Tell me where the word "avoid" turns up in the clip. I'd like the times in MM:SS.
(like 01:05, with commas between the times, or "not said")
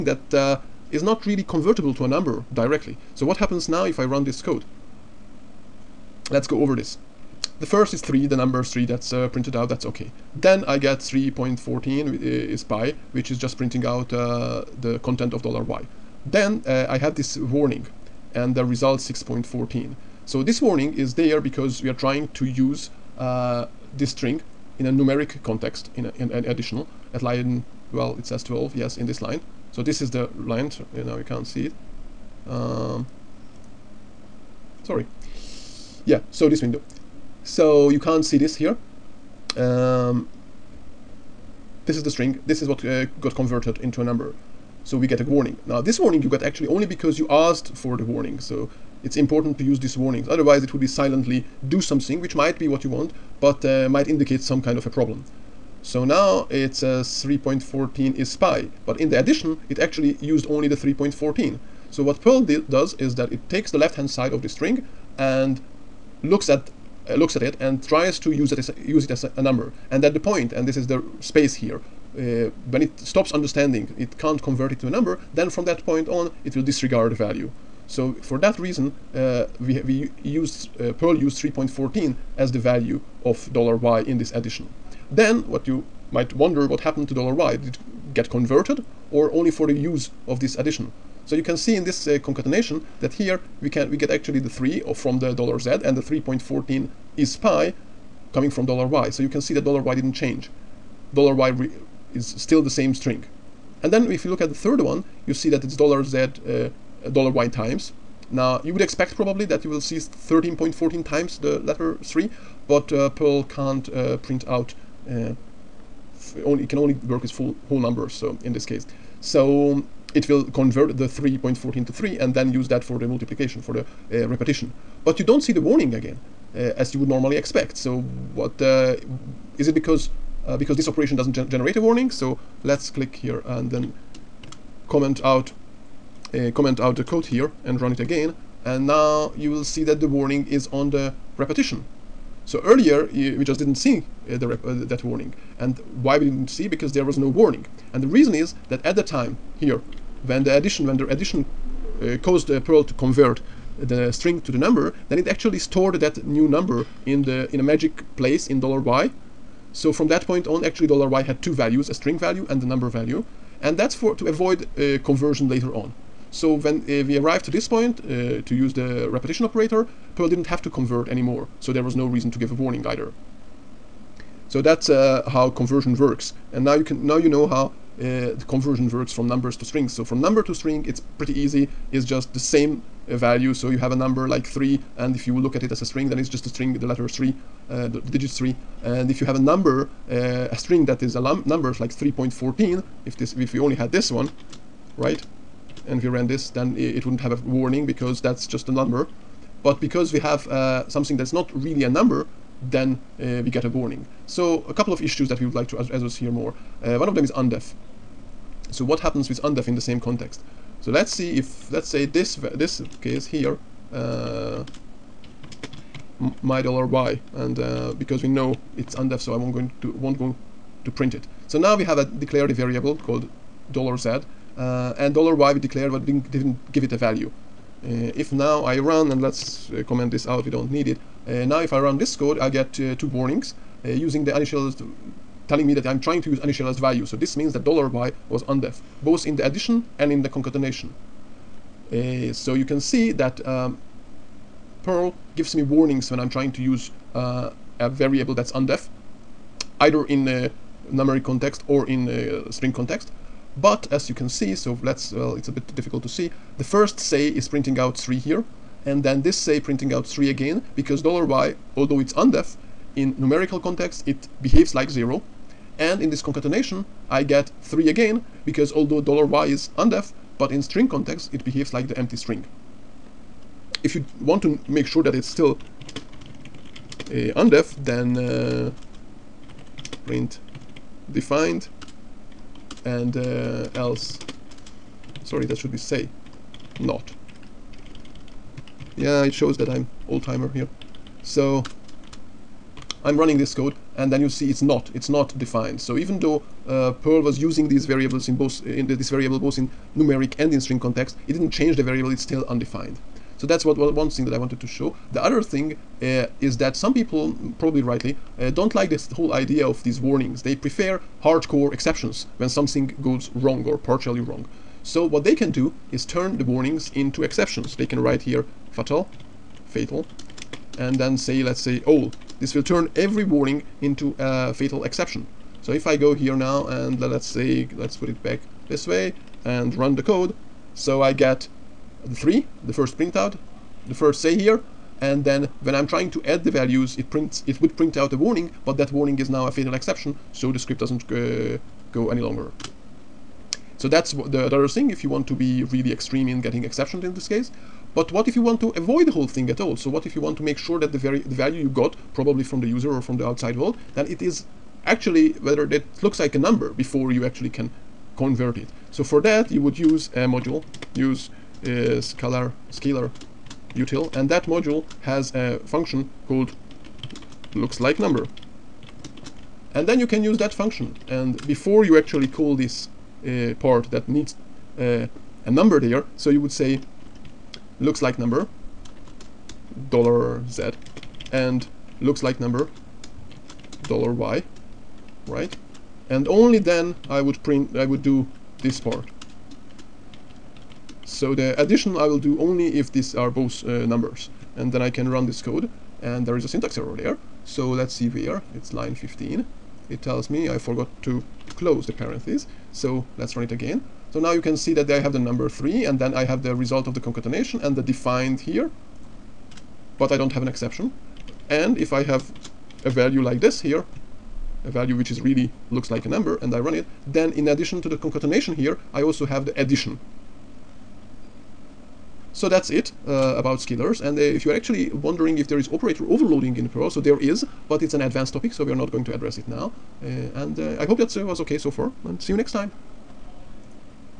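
02:44, 05:48.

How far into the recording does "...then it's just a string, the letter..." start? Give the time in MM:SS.
03:06.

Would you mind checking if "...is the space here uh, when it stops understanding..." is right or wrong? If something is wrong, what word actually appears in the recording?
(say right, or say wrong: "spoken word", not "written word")
right.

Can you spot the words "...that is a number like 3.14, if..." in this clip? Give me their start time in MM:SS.
03:10.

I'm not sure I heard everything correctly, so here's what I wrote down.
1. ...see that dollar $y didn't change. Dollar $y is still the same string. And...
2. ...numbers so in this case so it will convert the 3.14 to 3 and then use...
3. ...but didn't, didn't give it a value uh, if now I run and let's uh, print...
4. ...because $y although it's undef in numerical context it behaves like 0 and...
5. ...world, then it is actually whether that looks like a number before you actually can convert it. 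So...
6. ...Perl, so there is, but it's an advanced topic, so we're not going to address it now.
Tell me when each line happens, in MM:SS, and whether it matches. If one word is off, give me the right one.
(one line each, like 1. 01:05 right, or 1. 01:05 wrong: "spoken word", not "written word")
1. 01:39 right
2. 01:57 right
3. 03:45 wrong: "comment", not "print"
4. 04:20 right
5. 05:53 right
6. 07:06 right.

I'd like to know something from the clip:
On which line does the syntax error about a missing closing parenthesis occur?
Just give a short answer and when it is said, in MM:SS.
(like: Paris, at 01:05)
15, at 06:38.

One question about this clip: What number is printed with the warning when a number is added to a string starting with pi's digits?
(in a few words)
6.14.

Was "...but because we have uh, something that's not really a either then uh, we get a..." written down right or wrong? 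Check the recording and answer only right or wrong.
wrong.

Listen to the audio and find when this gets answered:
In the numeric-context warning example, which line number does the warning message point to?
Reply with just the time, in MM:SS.
00:28.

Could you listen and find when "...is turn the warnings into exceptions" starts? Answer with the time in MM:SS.
05:15.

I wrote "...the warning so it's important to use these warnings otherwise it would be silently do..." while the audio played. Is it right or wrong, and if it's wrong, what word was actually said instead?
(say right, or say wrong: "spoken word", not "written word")
right.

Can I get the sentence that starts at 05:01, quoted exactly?
It didn't change the variable; it's still undefined.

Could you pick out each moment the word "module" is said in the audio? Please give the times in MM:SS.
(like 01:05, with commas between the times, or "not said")
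06:00, 06:04.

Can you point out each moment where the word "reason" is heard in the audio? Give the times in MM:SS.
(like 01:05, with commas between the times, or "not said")
01:18, 02:28, 02:52.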